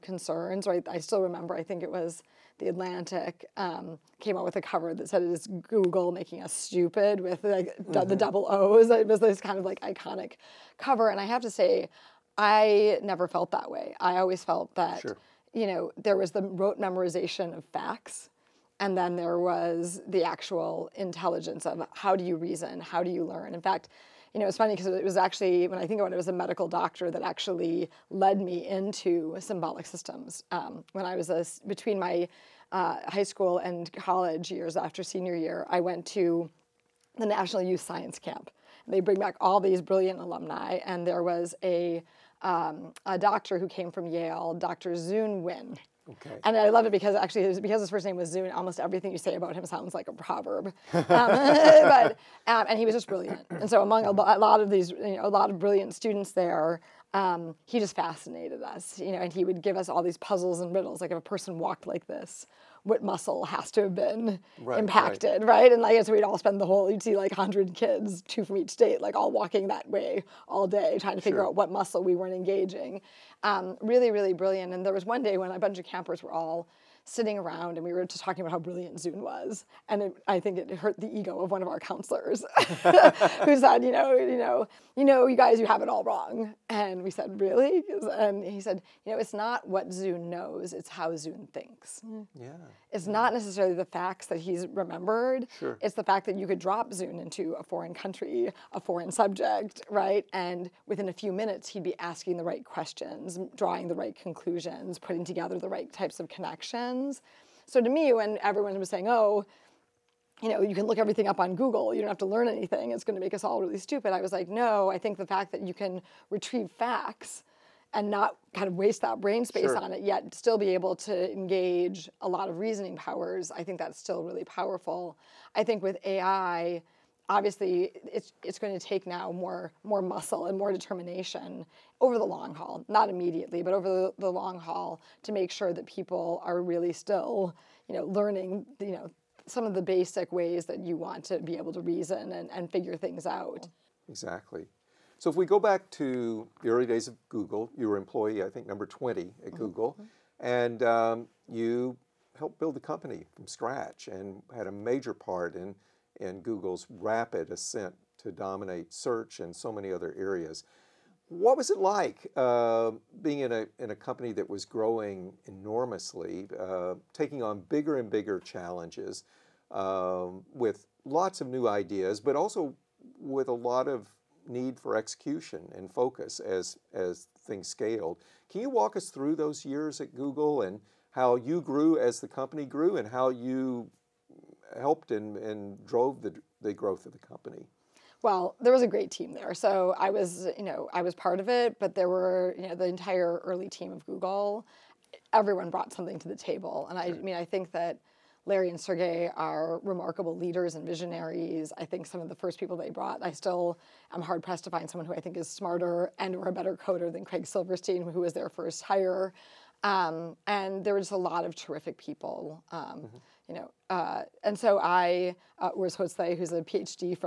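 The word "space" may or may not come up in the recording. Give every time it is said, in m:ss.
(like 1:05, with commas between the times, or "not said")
1:59.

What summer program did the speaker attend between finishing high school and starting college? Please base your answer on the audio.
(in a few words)
National Youth Science Camp.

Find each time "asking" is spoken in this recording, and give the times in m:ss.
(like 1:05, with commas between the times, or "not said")
1:41.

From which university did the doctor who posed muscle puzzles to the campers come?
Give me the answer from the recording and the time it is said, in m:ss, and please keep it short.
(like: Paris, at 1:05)
Yale, at 0:44.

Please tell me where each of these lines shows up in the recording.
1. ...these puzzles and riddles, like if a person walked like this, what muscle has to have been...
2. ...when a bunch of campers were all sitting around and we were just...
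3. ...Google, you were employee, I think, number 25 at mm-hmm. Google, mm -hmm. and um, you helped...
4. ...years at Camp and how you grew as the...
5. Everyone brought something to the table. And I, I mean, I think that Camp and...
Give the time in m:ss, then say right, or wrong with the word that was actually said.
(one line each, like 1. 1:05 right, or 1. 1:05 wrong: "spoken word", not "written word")
1. 1:00 right
2. 1:15 right
3. 2:27 wrong: "20", not "25"
4. 2:59 wrong: "Google", not "Camp"
5. 3:15 wrong: "Larry", not "Camp".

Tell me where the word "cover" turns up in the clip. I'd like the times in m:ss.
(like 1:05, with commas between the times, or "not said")
0:04, 0:10.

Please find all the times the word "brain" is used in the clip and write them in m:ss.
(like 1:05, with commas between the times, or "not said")
1:59.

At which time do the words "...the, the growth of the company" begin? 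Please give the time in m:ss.
3:06.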